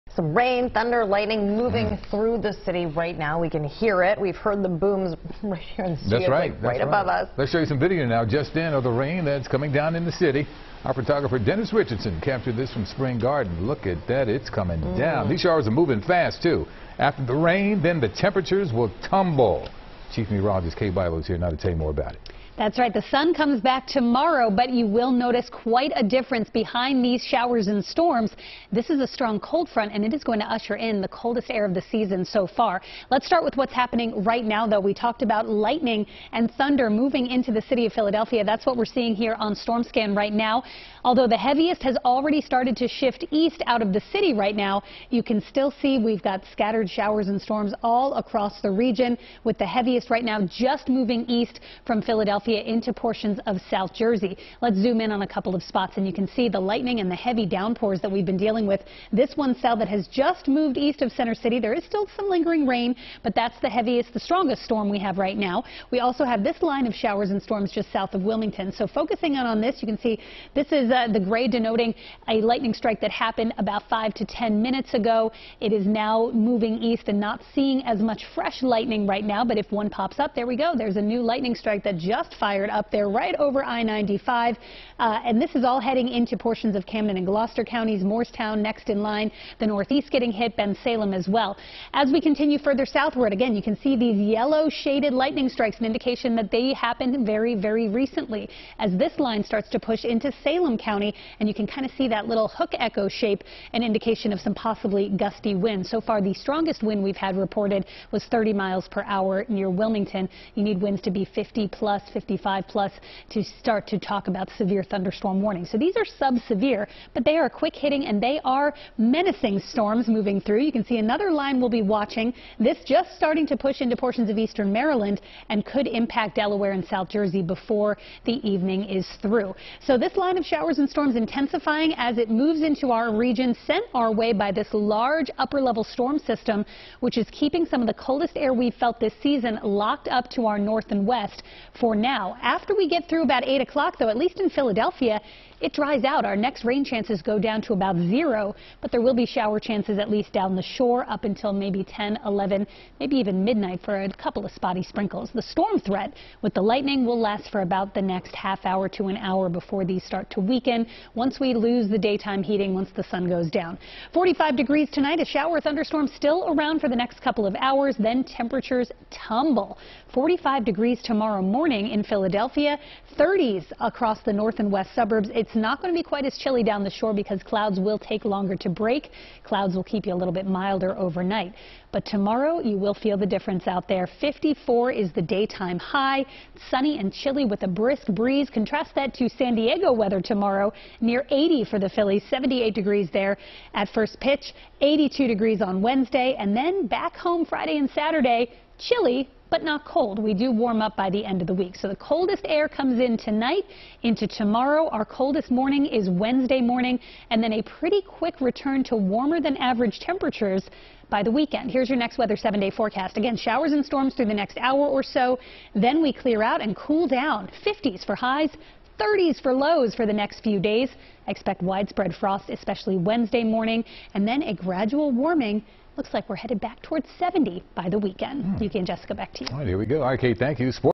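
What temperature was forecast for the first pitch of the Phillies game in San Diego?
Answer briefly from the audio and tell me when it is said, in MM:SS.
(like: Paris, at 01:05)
78 degrees, at 03:12.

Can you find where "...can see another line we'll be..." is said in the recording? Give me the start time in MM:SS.
02:00.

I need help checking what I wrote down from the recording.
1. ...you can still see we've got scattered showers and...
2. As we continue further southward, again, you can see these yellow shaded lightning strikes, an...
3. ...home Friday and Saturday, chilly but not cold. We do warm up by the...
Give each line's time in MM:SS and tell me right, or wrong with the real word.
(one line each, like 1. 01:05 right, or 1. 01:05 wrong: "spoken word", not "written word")
1. 00:45 right
2. 01:31 right
3. 03:17 right.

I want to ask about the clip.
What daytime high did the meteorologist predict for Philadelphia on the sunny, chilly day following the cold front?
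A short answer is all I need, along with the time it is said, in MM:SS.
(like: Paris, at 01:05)
54, at 03:04.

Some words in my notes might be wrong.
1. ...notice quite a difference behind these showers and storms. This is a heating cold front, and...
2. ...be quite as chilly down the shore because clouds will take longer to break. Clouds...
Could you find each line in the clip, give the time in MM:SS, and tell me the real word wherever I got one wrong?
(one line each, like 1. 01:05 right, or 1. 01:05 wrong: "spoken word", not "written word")
1. 00:25 wrong: "strong", not "heating"
2. 02:55 right.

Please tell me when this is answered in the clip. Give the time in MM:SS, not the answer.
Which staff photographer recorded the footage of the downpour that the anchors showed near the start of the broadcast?
00:11.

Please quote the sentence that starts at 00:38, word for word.
That's what we're seeing here on storm scan right now.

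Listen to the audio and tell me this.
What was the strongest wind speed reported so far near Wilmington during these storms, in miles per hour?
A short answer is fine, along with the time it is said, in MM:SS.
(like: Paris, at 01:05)
30, at 01:48.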